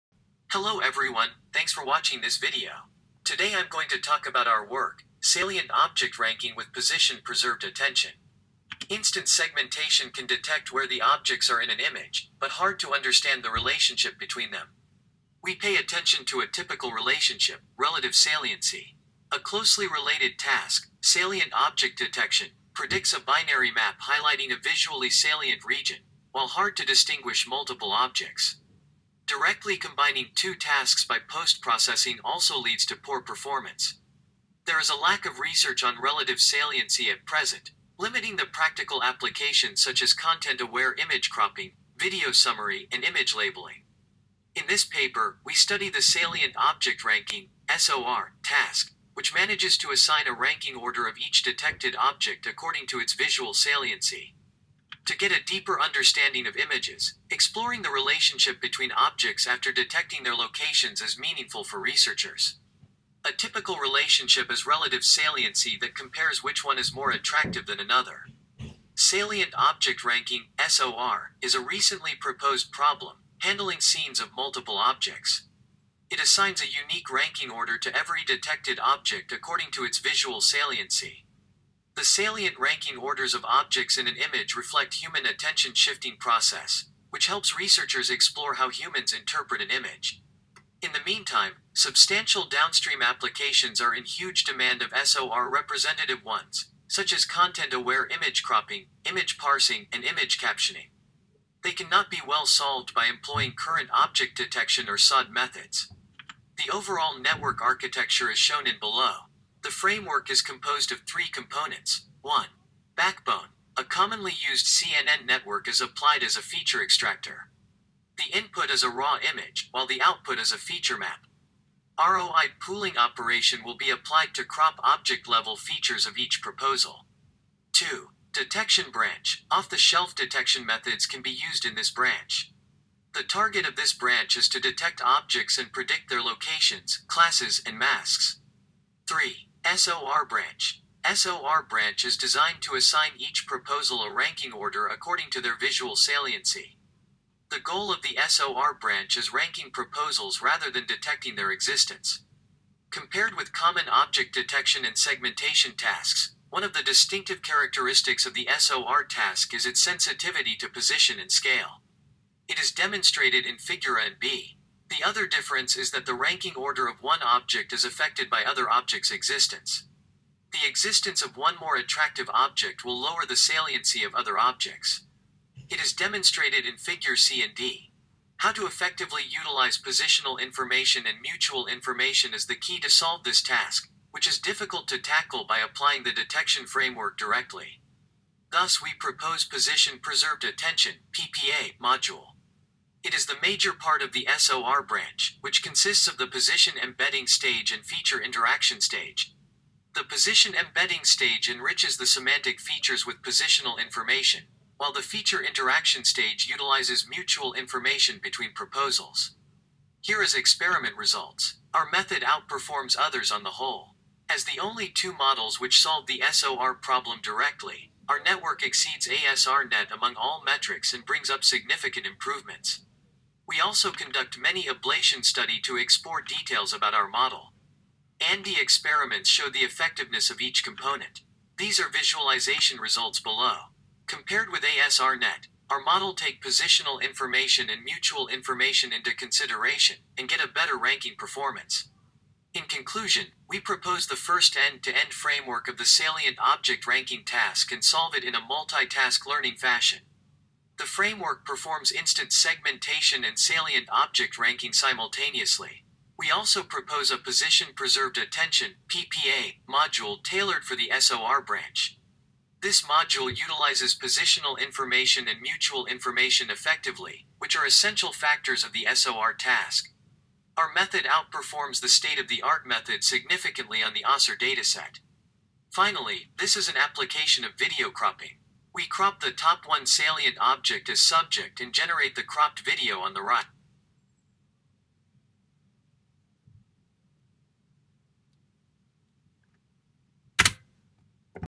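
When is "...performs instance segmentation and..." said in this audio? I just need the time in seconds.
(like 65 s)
251 s.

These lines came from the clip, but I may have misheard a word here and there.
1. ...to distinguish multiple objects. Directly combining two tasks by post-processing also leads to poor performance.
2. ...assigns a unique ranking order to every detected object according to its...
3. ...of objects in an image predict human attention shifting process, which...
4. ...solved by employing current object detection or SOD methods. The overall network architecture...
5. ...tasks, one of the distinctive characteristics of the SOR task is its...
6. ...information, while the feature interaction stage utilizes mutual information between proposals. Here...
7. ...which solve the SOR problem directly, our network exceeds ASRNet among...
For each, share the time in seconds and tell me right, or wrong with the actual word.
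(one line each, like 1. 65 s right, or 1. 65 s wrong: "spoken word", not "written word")
1. 26 s right
2. 76 s right
3. 83 s wrong: "reflect", not "predict"
4. 102 s right
5. 155 s right
6. 203 s right
7. 215 s right.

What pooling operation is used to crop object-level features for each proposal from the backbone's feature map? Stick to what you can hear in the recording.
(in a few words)
ROI pooling.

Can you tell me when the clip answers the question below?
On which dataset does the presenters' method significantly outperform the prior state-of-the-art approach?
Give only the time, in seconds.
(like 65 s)
274 s.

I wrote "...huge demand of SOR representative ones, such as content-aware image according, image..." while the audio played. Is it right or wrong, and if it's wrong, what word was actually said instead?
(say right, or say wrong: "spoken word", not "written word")
wrong: "cropping", not "according".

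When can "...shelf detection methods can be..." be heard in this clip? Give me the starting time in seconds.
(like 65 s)
129 s.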